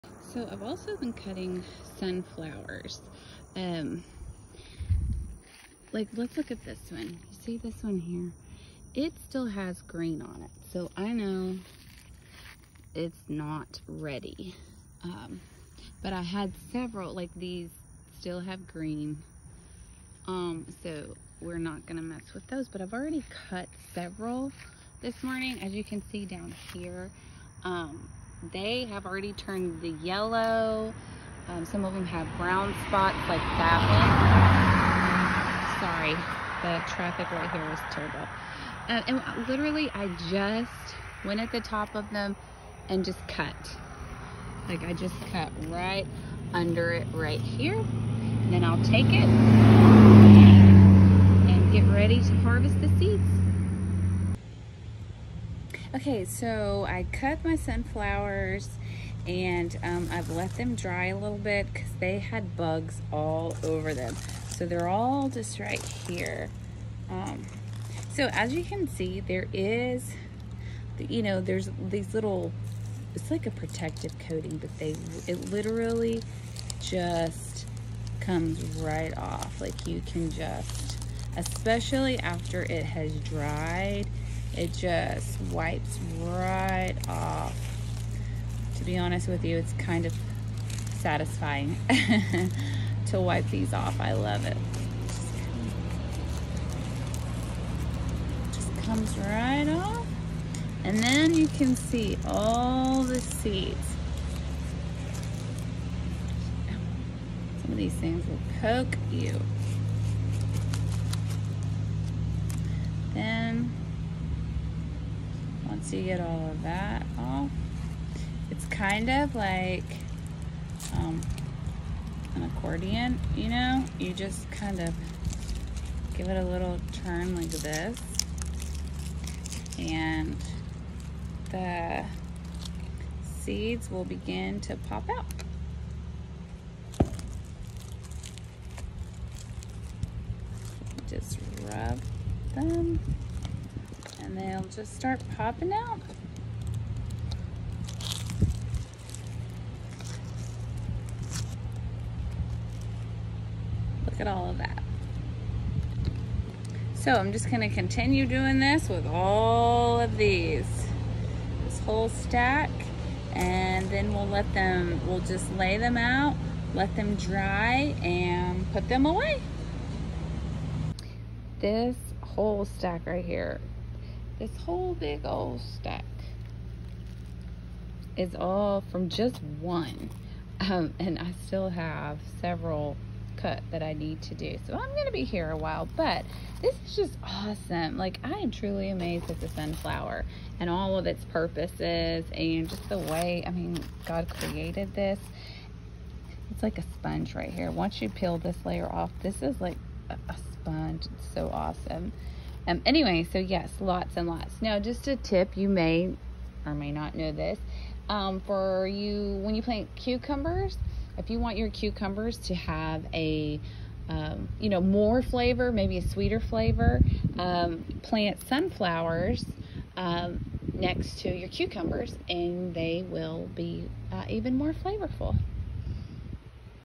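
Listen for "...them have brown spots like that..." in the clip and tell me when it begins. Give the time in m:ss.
0:31.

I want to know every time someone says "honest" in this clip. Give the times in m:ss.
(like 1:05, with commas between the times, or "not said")
1:28.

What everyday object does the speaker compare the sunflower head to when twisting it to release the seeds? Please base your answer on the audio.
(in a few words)
An accordion.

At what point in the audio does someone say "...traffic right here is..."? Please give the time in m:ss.
0:36.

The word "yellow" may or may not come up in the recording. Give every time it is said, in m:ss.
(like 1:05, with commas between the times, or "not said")
0:30.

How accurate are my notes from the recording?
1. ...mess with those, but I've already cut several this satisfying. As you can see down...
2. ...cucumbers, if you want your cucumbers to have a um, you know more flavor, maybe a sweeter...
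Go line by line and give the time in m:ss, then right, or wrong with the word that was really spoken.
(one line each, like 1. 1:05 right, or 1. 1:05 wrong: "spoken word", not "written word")
1. 0:22 wrong: "morning", not "satisfying"
2. 3:29 right.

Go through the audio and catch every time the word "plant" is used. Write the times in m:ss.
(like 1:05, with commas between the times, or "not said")
3:29, 3:38.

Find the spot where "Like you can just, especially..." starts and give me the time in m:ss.
1:19.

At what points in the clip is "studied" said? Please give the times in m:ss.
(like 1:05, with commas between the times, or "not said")
not said.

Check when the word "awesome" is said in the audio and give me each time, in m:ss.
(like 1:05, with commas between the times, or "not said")
3:07, 3:21.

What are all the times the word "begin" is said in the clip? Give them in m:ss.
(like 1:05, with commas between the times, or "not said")
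2:14.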